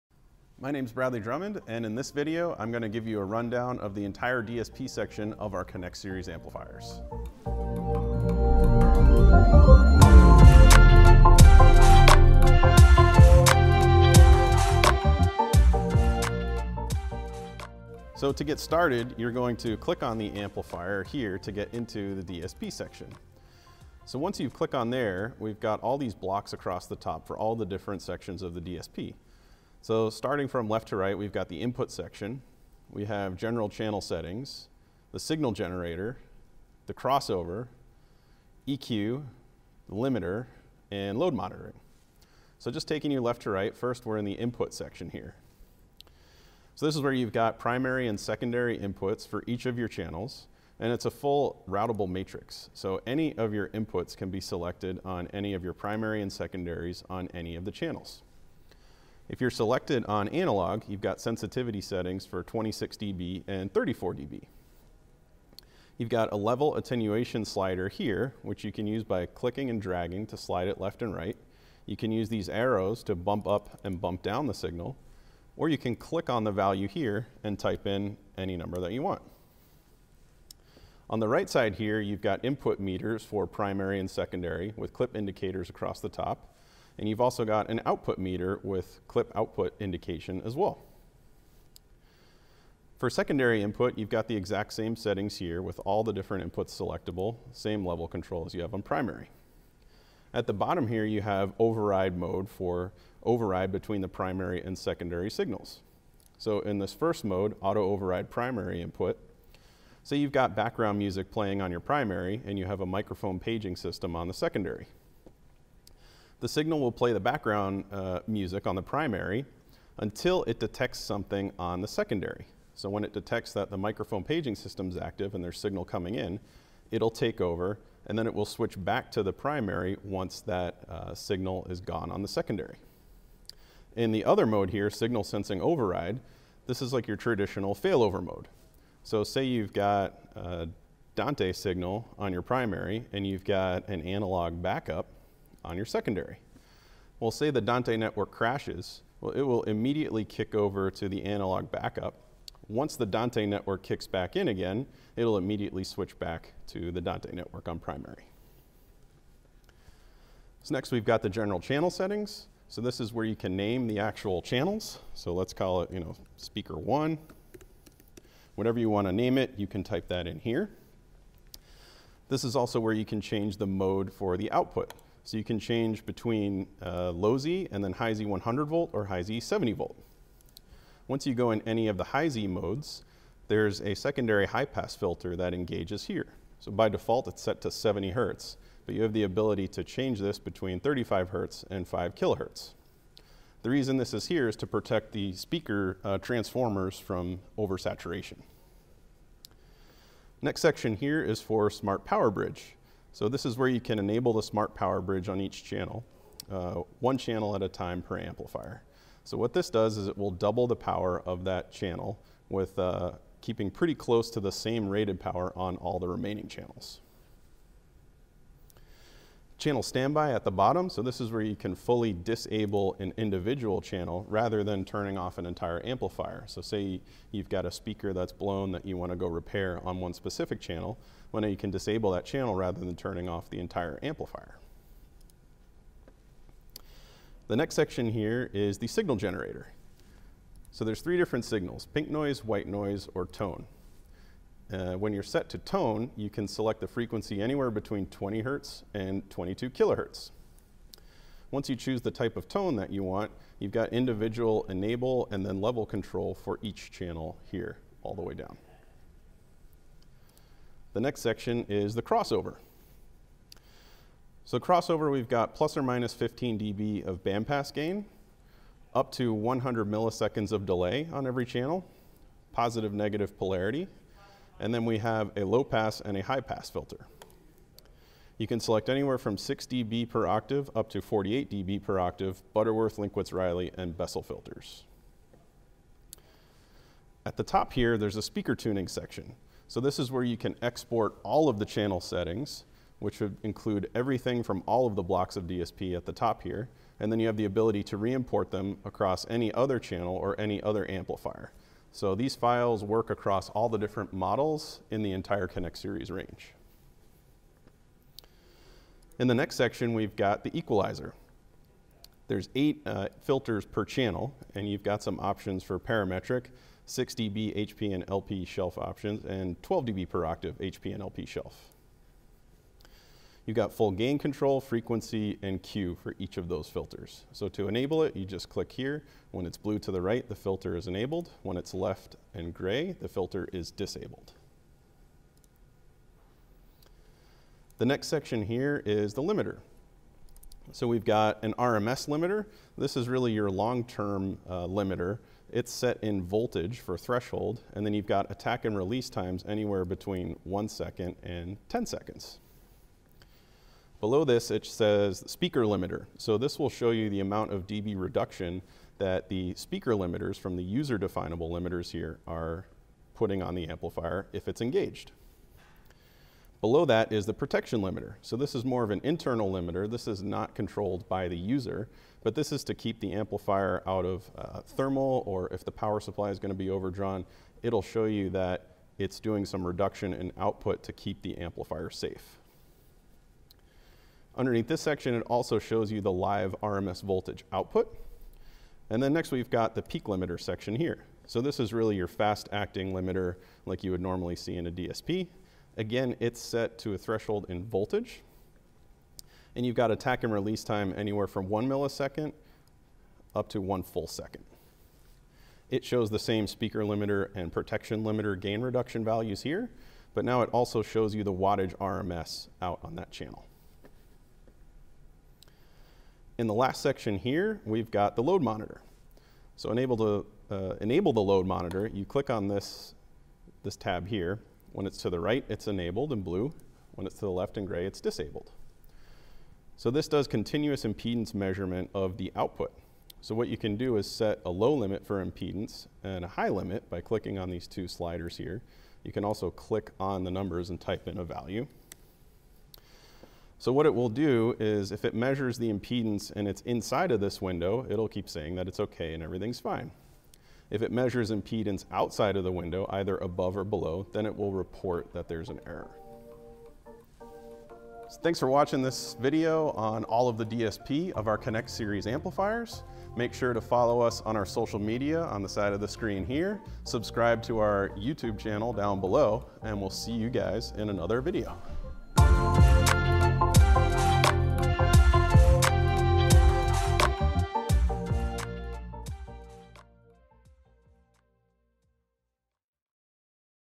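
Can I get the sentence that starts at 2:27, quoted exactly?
Well, say the Dante network crashes, well, it will immediately kick over to the analog backup.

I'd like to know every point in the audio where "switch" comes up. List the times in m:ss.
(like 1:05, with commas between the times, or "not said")
2:08, 2:35.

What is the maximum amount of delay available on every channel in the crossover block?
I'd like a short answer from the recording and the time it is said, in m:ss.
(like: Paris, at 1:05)
100 milliseconds, at 4:29.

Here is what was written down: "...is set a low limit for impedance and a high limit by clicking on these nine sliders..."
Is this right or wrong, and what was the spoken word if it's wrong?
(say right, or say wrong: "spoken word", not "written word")
wrong: "two", not "nine".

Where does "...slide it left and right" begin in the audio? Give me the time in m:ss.
1:10.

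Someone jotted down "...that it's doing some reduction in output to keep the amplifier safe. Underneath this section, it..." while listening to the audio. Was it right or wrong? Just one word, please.
right.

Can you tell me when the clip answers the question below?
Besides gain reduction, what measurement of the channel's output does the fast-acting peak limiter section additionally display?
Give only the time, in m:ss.
6:51.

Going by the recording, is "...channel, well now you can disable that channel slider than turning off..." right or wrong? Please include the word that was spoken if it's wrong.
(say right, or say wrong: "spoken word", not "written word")
wrong: "rather", not "slider".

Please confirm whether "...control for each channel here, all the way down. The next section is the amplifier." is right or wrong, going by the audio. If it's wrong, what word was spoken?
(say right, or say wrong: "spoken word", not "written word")
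wrong: "crossover", not "amplifier".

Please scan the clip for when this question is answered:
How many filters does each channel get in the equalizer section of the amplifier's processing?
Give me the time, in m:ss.
5:12.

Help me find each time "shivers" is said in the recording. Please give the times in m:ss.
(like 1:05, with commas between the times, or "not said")
not said.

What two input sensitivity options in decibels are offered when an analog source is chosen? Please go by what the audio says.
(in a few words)
26 dB and 34 dB.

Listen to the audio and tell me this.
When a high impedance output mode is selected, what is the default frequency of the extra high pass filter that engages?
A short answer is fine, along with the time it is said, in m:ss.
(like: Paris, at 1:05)
70 hertz, at 3:07.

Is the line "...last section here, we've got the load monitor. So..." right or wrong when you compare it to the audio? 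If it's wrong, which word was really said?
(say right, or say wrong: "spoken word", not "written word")
right.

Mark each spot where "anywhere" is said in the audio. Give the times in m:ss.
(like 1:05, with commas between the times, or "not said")
4:07, 4:38, 5:49, 6:40.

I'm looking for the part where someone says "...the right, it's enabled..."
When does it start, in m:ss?
7:05.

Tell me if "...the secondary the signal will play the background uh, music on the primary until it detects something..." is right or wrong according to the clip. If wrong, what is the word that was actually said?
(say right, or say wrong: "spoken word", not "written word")
right.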